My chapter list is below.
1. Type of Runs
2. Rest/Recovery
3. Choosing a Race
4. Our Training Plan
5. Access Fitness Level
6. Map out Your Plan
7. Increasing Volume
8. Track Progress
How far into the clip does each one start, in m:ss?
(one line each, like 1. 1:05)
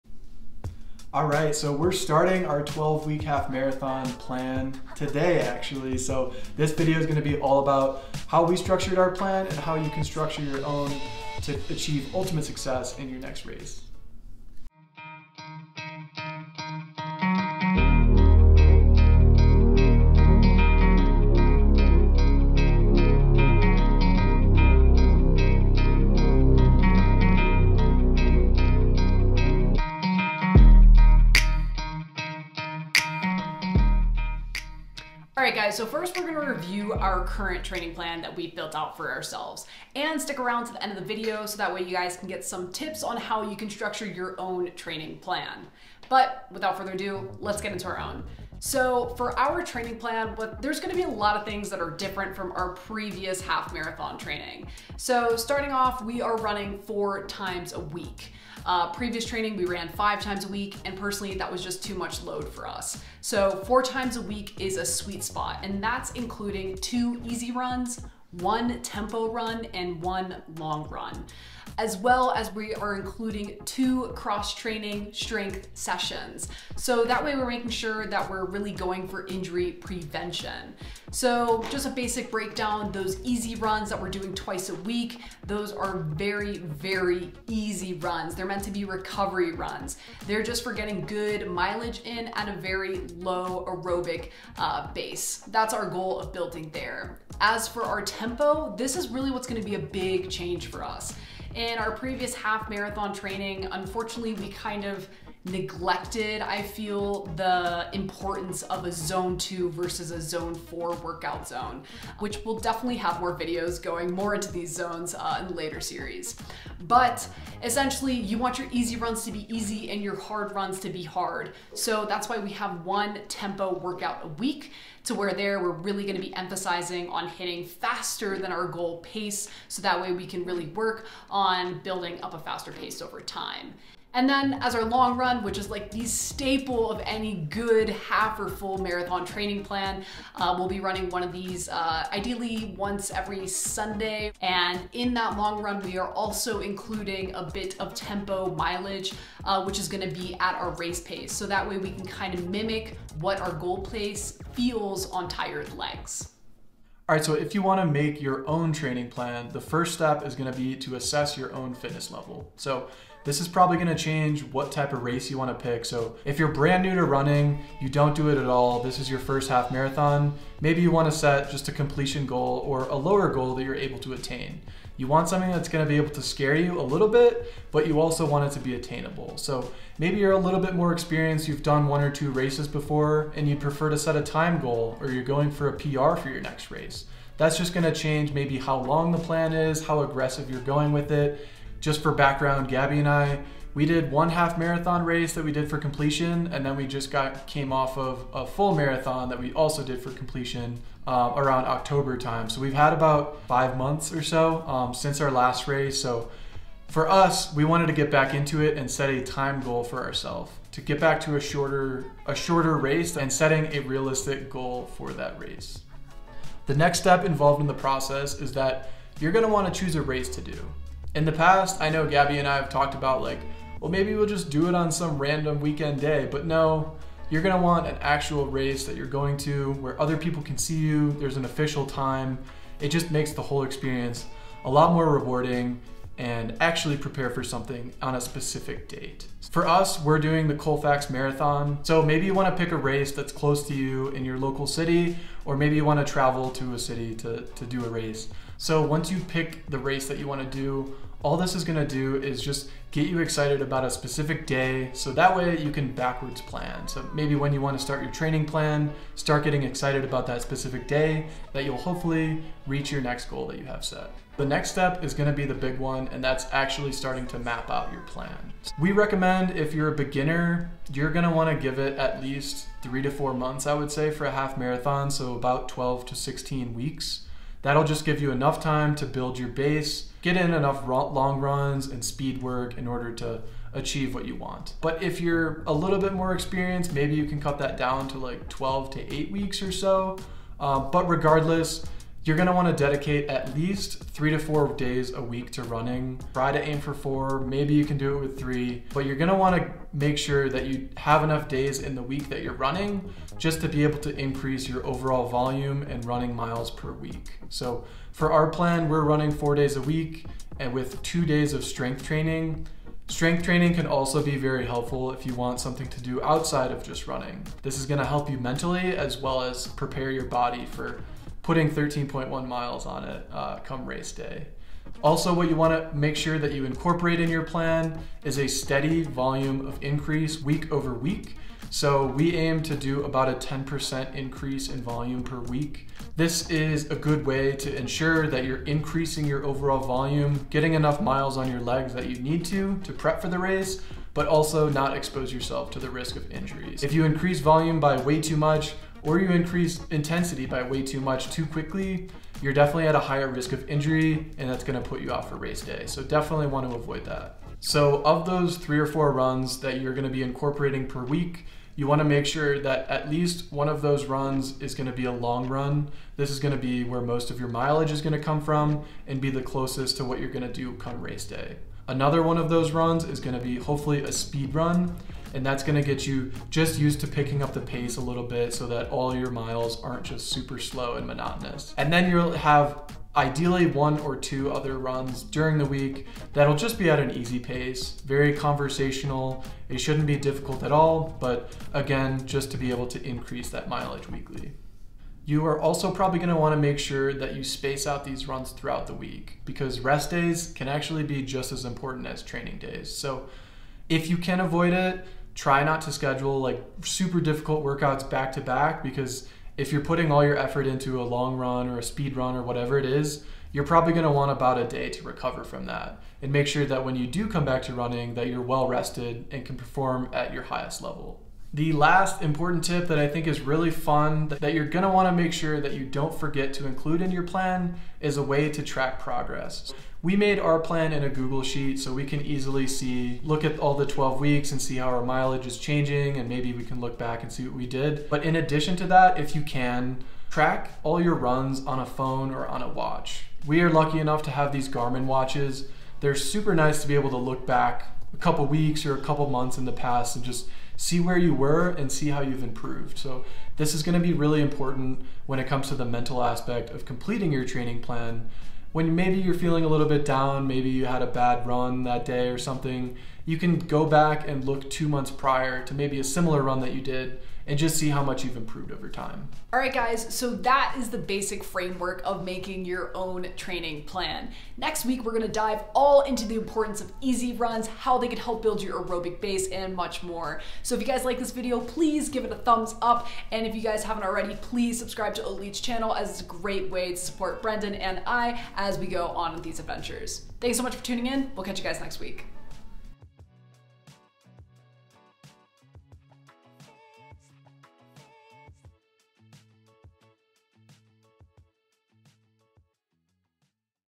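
1. 5:57
2. 6:34
3. 3:36
4. 0:48
5. 2:36
6. 4:24
7. 5:24
8. 7:01.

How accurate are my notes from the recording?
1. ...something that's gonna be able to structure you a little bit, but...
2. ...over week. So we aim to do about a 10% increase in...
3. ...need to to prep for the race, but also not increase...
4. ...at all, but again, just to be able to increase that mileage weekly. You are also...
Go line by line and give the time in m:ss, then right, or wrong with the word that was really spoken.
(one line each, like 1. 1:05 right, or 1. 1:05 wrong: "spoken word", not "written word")
1. 2:55 wrong: "scare", not "structure"
2. 5:30 right
3. 5:42 wrong: "expose", not "increase"
4. 6:30 right.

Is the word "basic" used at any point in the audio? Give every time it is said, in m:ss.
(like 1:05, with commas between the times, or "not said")
1:21, 7:50.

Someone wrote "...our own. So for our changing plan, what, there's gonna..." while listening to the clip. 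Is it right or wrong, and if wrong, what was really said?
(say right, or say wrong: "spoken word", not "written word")
wrong: "training", not "changing".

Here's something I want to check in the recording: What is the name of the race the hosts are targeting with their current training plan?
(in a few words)
Colfax Marathon.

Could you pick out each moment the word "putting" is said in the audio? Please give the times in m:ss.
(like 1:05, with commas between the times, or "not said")
5:21, 6:49.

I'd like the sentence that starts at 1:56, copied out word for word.
But essentially, you want your easy runs to be easy and your hard runs to be hard.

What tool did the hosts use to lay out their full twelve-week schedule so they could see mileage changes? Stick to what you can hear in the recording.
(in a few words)
Google Sheet.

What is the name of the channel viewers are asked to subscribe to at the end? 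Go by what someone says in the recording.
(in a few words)
Oatletes.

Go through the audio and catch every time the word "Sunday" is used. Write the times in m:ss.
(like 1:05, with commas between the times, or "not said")
2:23.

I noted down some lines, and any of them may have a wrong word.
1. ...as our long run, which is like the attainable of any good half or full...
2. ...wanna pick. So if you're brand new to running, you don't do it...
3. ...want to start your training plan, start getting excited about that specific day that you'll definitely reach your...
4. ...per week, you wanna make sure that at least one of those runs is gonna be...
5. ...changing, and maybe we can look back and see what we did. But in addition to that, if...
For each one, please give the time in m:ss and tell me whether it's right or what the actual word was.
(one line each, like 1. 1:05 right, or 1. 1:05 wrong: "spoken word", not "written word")
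1. 2:14 wrong: "staple", not "attainable"
2. 2:45 right
3. 4:17 wrong: "hopefully", not "definitely"
4. 6:00 right
5. 7:15 right.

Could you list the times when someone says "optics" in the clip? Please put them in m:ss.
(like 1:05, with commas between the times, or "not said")
not said.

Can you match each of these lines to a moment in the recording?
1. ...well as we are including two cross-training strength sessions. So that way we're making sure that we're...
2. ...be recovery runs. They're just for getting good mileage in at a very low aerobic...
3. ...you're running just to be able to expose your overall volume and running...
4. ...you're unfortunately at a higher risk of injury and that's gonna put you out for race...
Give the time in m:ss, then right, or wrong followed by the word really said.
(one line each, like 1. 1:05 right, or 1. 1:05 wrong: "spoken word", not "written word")
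1. 1:11 right
2. 1:28 right
3. 5:02 wrong: "increase", not "expose"
4. 5:52 wrong: "definitely", not "unfortunately".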